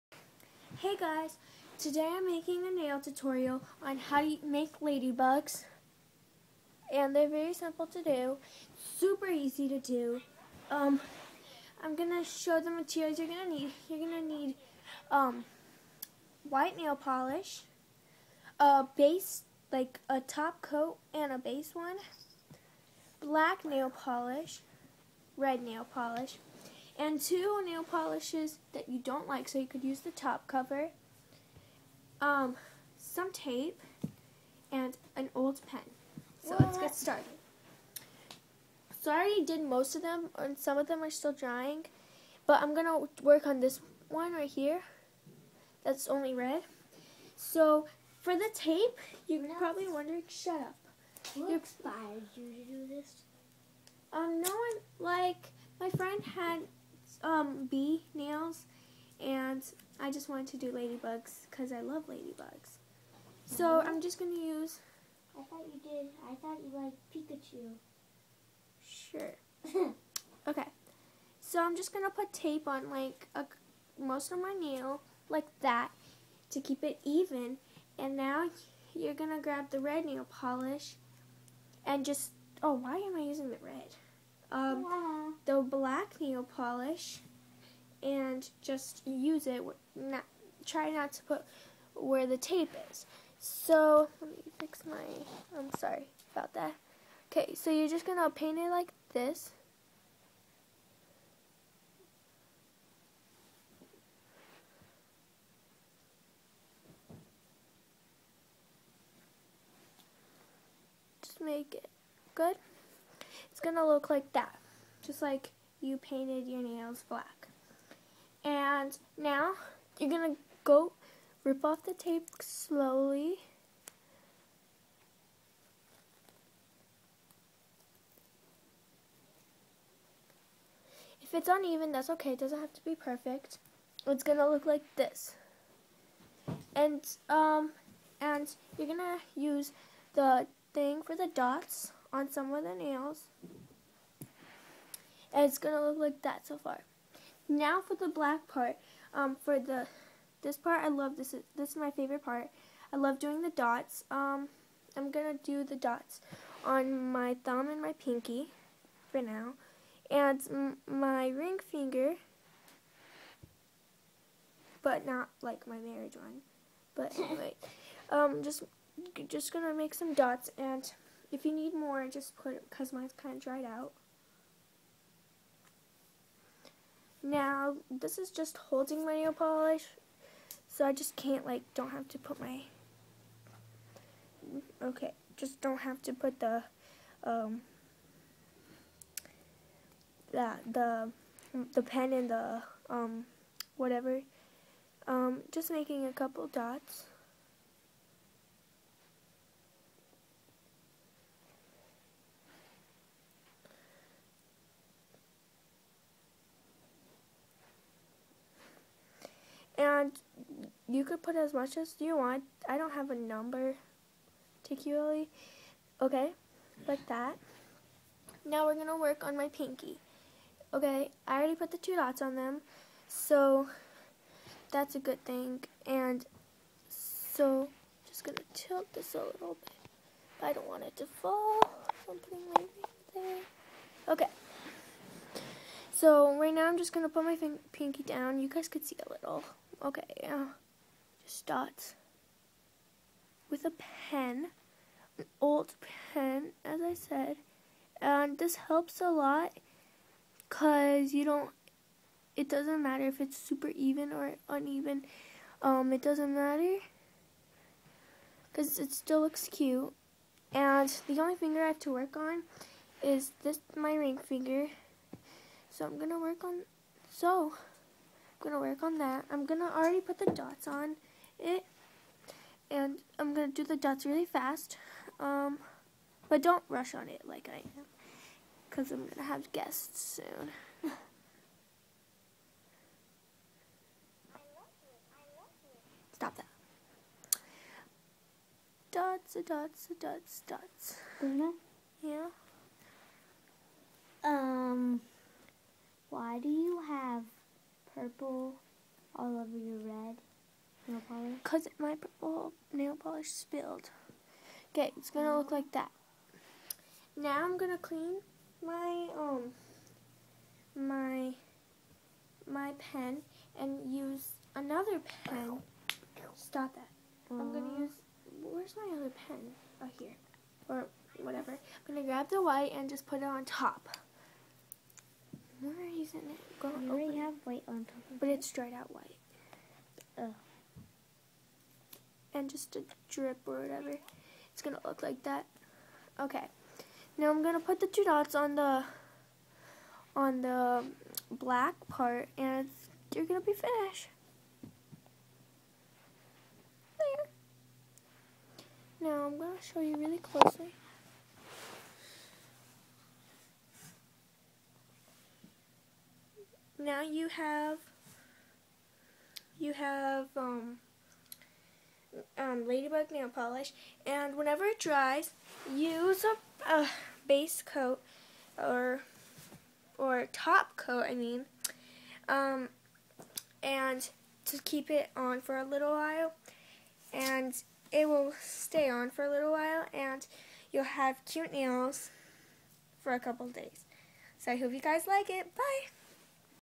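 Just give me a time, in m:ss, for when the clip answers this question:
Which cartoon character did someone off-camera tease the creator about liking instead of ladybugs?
1:07.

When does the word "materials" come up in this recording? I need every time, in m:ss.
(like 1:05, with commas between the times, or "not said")
0:12.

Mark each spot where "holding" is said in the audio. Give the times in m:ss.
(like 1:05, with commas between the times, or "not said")
2:58.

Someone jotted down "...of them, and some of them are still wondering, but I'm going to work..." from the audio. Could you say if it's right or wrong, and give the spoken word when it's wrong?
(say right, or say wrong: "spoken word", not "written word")
wrong: "drying", not "wondering".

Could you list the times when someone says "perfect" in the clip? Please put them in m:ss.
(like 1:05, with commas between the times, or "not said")
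2:12.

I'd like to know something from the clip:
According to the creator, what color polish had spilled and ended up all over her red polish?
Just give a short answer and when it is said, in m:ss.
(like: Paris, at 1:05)
Purple, at 4:57.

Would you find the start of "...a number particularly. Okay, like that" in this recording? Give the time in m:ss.
3:33.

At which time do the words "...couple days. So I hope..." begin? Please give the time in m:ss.
6:23.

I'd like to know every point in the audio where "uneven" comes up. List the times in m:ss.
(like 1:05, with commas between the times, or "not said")
2:11, 4:14.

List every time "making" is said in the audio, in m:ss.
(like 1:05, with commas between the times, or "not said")
0:02, 3:15.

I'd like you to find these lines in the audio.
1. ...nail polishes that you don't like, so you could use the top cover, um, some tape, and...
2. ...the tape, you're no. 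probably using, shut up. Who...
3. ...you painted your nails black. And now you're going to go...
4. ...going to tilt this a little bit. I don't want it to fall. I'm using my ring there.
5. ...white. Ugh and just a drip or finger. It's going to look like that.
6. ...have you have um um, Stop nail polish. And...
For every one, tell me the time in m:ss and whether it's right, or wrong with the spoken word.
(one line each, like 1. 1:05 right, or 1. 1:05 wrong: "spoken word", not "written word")
1. 0:27 right
2. 0:48 wrong: "wondering", not "using"
3. 1:55 right
4. 3:48 wrong: "putting", not "using"
5. 5:28 wrong: "whatever", not "finger"
6. 5:57 wrong: "Ladybug", not "Stop".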